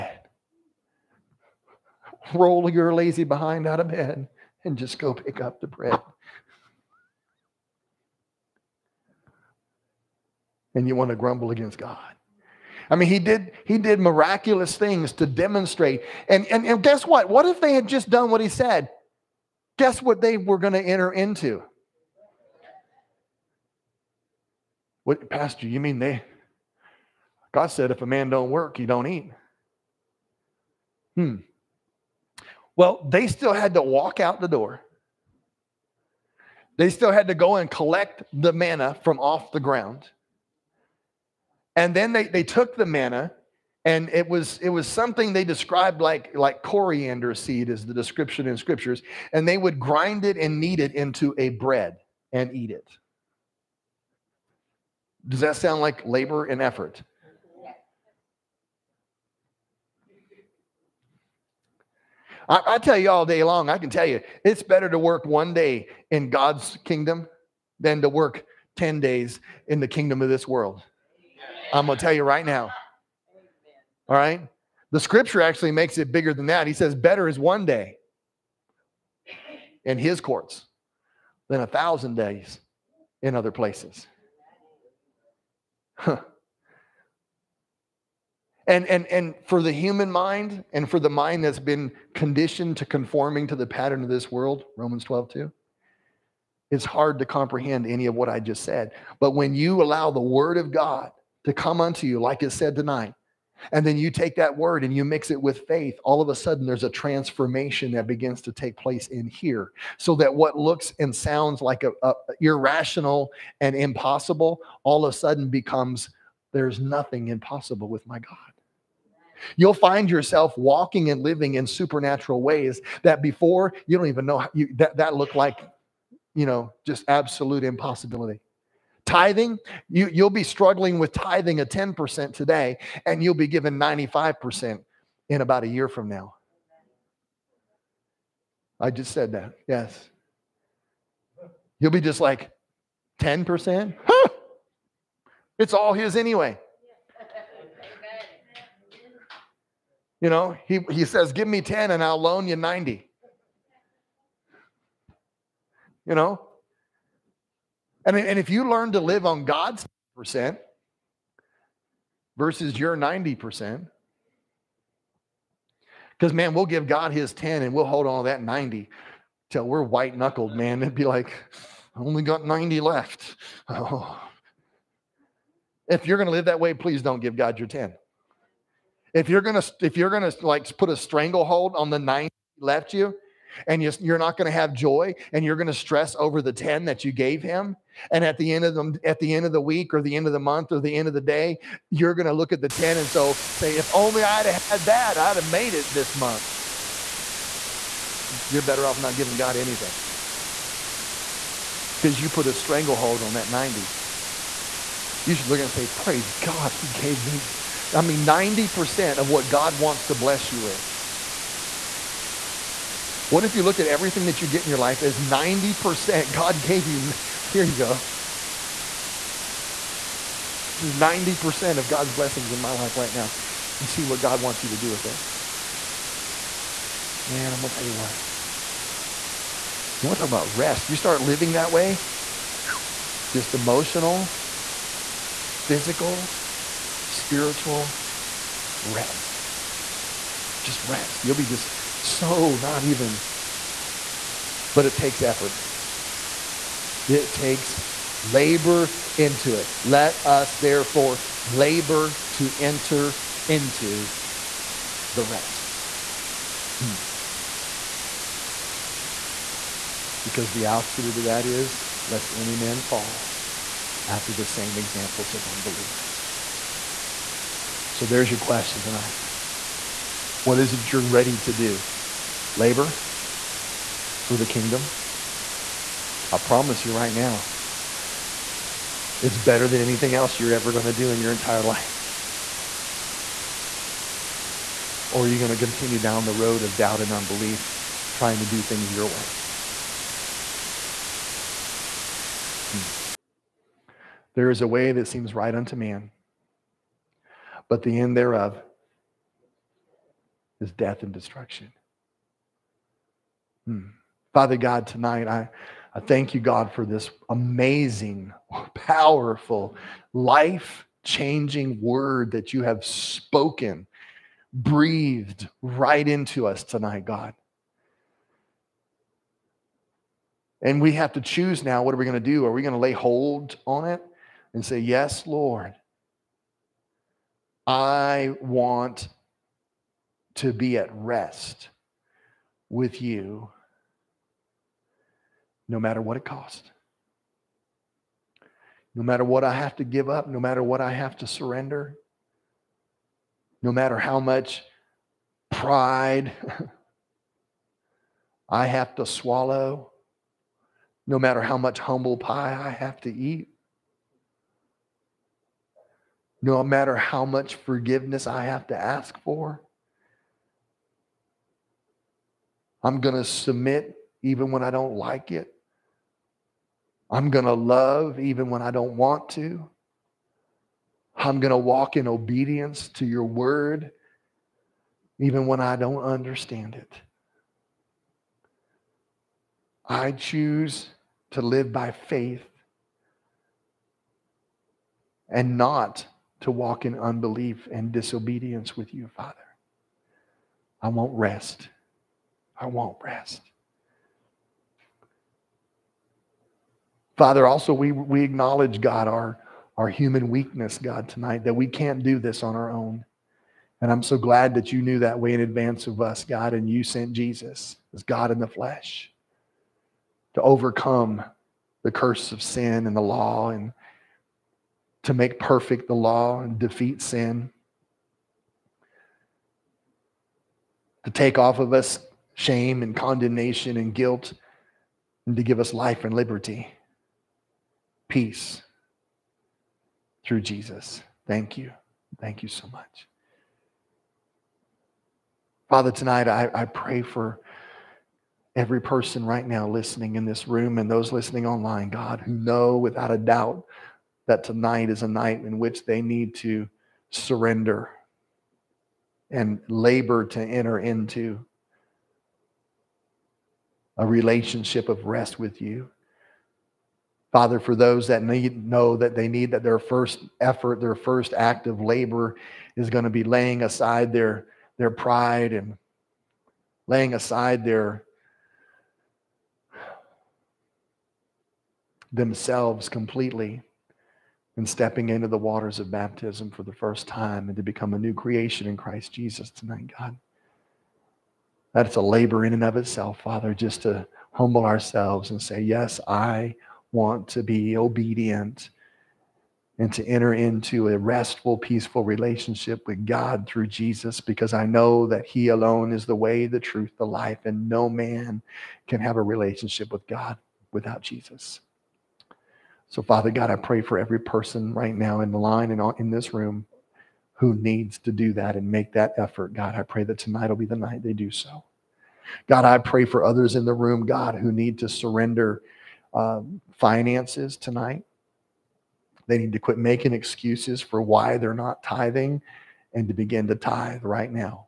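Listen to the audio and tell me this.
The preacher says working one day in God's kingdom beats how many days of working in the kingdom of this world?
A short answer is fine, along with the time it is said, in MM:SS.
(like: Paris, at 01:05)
10, at 01:08.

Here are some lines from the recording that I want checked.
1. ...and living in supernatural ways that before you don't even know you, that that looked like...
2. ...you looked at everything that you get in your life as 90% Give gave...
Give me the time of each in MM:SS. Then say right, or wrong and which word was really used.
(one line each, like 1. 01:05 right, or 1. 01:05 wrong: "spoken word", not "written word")
1. 02:01 right
2. 03:33 wrong: "God", not "Give".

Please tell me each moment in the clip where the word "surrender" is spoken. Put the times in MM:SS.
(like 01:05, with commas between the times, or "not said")
05:41, 07:27, 08:34.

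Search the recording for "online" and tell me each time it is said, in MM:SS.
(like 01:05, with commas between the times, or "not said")
07:21.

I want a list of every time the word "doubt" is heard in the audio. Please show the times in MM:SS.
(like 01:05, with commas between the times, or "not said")
04:46, 07:23.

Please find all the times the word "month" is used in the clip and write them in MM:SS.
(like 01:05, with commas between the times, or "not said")
03:10, 03:16.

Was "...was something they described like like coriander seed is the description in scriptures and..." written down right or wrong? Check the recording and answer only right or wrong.
right.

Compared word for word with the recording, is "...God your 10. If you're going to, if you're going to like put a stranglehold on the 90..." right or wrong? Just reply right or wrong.
right.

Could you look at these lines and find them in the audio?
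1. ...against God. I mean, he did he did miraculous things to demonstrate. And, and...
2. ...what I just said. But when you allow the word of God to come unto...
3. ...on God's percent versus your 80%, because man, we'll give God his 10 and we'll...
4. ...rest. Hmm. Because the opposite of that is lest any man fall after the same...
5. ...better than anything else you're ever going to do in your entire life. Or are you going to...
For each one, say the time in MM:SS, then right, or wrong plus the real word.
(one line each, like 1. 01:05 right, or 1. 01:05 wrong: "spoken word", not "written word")
1. 00:11 right
2. 01:38 right
3. 02:39 wrong: "90", not "80"
4. 04:15 right
5. 04:39 right.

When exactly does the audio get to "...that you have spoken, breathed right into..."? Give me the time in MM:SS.
05:12.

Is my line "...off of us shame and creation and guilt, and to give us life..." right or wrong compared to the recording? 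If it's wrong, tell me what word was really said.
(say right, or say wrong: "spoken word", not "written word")
wrong: "condemnation", not "creation".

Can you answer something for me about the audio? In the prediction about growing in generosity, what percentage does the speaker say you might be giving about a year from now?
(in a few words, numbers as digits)
95%.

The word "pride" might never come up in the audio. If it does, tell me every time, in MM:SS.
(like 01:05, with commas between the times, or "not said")
05:45, 07:44.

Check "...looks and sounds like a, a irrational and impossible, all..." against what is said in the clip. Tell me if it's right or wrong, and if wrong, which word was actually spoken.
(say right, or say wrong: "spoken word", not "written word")
right.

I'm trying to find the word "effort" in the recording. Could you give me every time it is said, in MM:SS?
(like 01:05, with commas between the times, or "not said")
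00:56, 04:05, 07:40, 08:29.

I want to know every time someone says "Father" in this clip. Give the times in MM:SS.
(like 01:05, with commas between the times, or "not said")
05:04, 06:29, 06:37, 07:15, 07:37, 08:03, 08:23.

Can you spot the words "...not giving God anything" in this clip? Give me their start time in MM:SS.
03:18.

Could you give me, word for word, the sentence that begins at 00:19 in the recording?
Guess what they were going to enter into?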